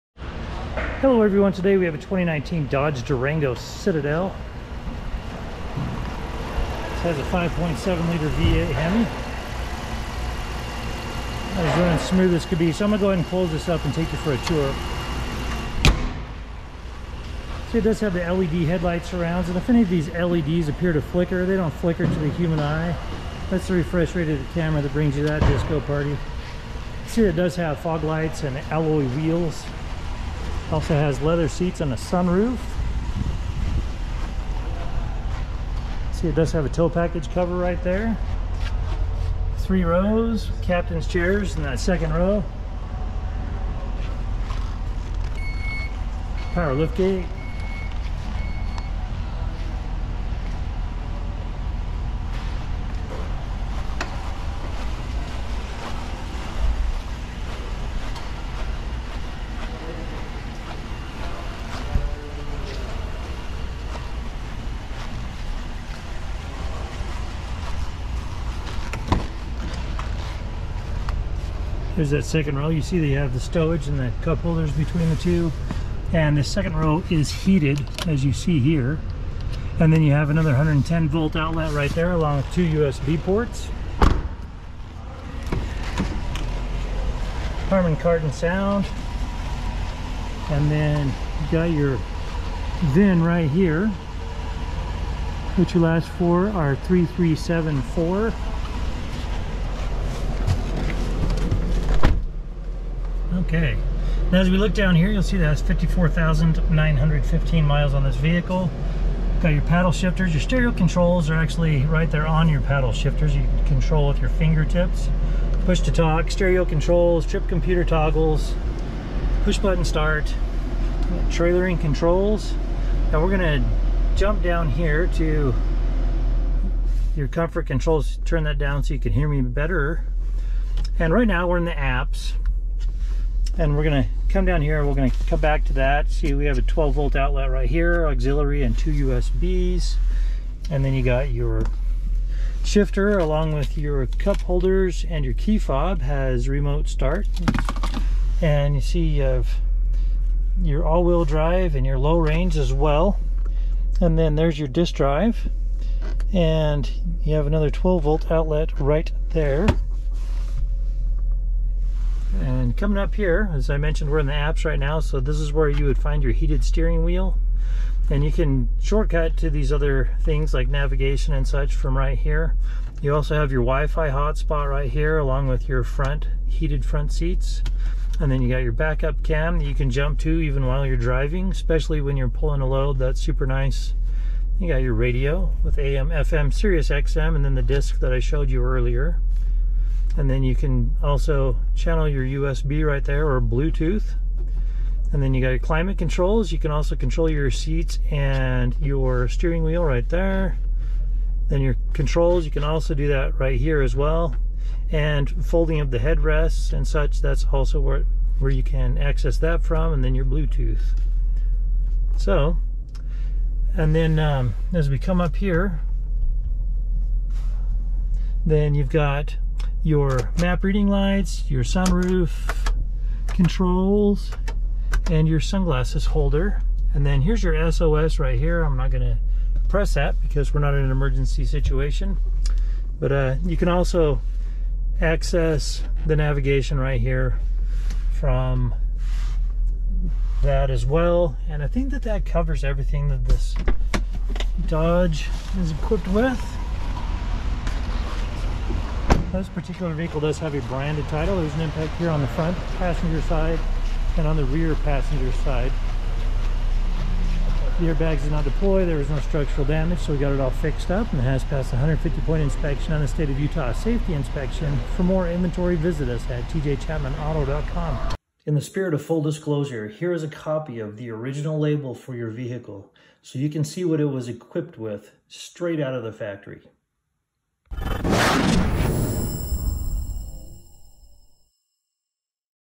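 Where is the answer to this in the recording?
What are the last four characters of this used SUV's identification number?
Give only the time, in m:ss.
1:36.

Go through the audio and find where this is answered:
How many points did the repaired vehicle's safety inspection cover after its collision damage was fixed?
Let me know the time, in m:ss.
4:21.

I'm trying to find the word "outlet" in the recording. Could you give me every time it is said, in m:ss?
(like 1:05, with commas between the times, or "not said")
1:21, 2:17, 2:38.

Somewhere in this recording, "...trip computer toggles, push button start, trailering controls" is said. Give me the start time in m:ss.
1:57.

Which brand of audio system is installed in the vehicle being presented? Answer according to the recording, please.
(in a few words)
Harman Kardon.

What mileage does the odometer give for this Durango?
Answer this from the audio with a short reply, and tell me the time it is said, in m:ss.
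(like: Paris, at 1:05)
54,915, at 1:45.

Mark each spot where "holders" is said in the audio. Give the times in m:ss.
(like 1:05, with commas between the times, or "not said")
1:14, 2:24, 3:46.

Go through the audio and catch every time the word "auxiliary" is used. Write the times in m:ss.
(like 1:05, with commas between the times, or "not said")
2:18.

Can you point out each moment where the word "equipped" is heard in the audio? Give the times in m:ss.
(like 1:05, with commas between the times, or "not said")
4:05, 4:34.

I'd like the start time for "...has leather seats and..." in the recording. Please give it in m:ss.
0:30.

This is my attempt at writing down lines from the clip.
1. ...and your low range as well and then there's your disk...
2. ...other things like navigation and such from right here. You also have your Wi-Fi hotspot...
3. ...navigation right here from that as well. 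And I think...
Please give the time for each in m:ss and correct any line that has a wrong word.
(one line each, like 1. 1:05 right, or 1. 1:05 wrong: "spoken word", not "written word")
1. 2:31 right
2. 2:49 right
3. 3:56 right.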